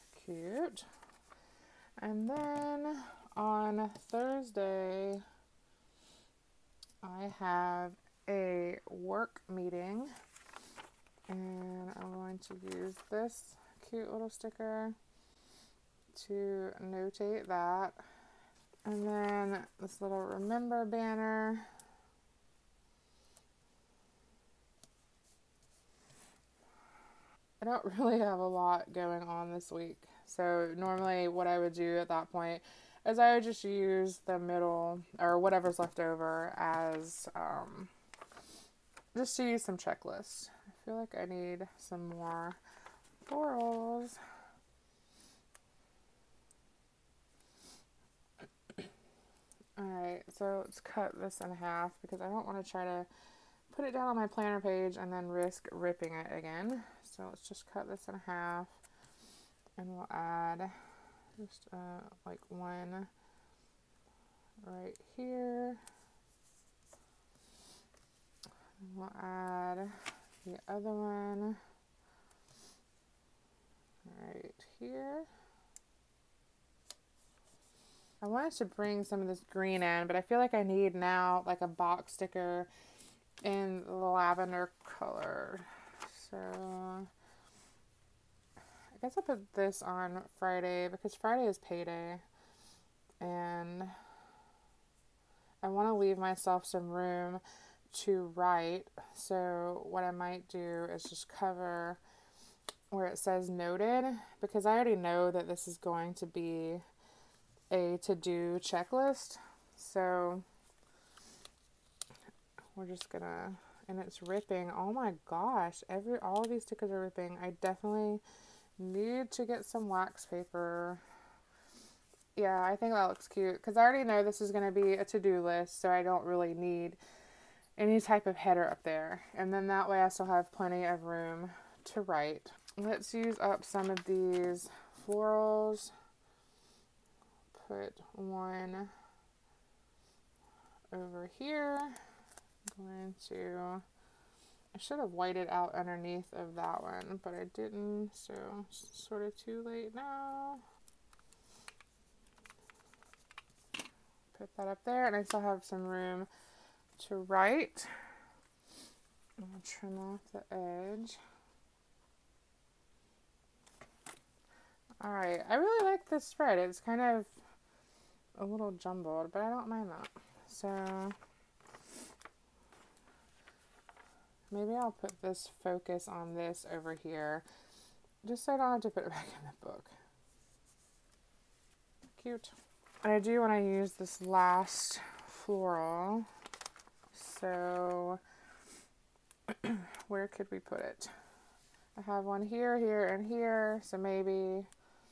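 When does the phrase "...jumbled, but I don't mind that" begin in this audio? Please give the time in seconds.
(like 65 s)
168 s.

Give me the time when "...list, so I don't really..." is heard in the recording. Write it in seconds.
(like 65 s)
125 s.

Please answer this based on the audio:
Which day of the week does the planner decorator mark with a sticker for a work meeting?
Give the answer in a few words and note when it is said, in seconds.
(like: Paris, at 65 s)
Thursday, at 4 s.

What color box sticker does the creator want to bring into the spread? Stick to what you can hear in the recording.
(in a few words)
Lavender.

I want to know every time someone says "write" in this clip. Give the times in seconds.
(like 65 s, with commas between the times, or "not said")
98 s, 132 s, 157 s.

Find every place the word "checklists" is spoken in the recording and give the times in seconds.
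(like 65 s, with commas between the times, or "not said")
39 s, 108 s.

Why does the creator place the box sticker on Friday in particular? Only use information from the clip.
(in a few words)
Payday.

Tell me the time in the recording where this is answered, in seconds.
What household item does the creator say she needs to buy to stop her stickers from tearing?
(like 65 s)
119 s.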